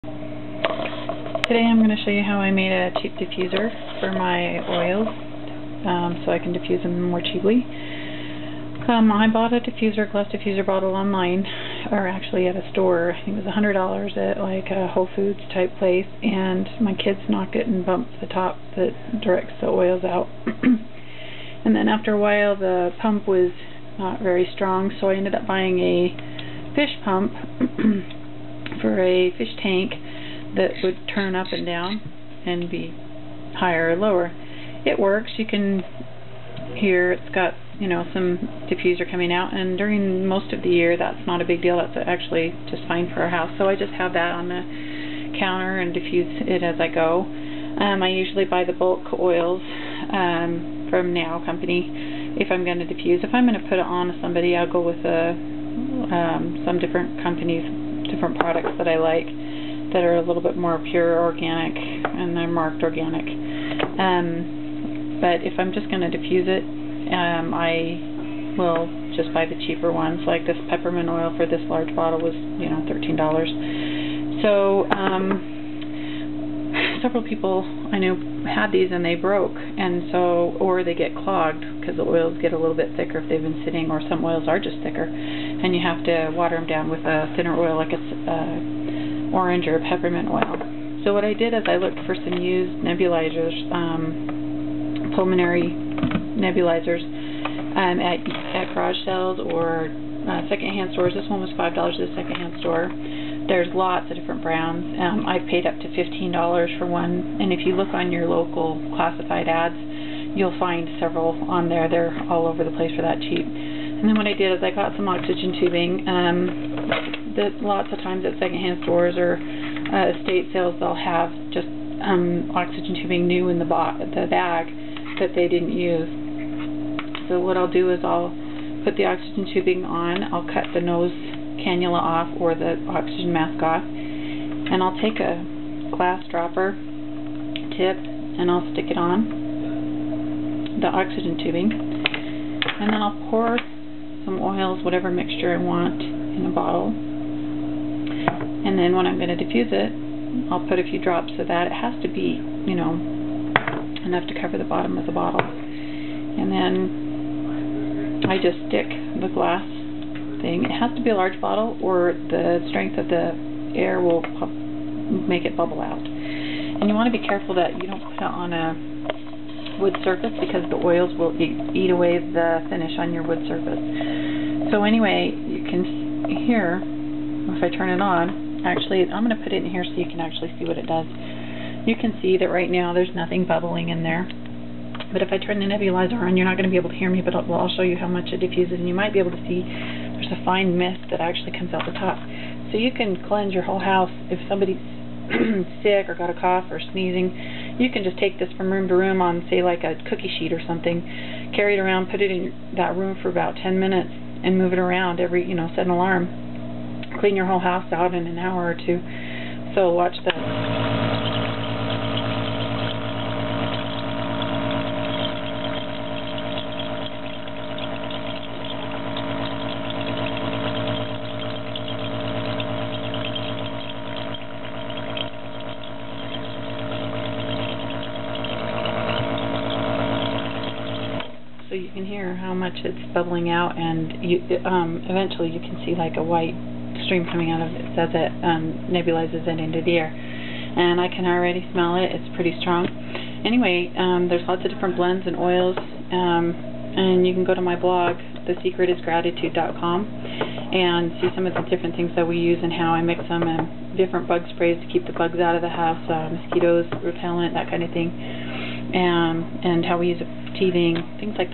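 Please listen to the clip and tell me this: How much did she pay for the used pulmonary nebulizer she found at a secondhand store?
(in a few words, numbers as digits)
$5.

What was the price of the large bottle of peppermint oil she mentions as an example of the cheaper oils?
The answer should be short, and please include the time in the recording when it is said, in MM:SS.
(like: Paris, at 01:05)
$13, at 01:12.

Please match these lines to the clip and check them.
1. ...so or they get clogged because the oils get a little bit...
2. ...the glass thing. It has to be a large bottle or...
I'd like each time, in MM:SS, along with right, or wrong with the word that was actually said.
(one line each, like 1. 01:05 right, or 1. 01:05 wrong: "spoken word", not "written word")
1. 01:20 right
2. 02:39 right.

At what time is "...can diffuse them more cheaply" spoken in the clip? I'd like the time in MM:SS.
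00:06.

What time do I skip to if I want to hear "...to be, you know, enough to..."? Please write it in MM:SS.
02:32.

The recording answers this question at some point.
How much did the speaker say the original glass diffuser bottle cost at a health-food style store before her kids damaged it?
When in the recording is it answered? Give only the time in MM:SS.
00:13.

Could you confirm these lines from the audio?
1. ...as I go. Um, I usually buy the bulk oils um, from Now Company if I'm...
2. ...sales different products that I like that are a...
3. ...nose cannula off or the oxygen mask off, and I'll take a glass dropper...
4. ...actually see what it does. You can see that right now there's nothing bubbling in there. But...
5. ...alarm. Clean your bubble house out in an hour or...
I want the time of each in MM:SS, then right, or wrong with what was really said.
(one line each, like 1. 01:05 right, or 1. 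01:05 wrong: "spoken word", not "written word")
1. 00:46 right
2. 00:57 wrong: "companies", not "sales"
3. 02:10 right
4. 03:00 right
5. 03:25 wrong: "whole", not "bubble".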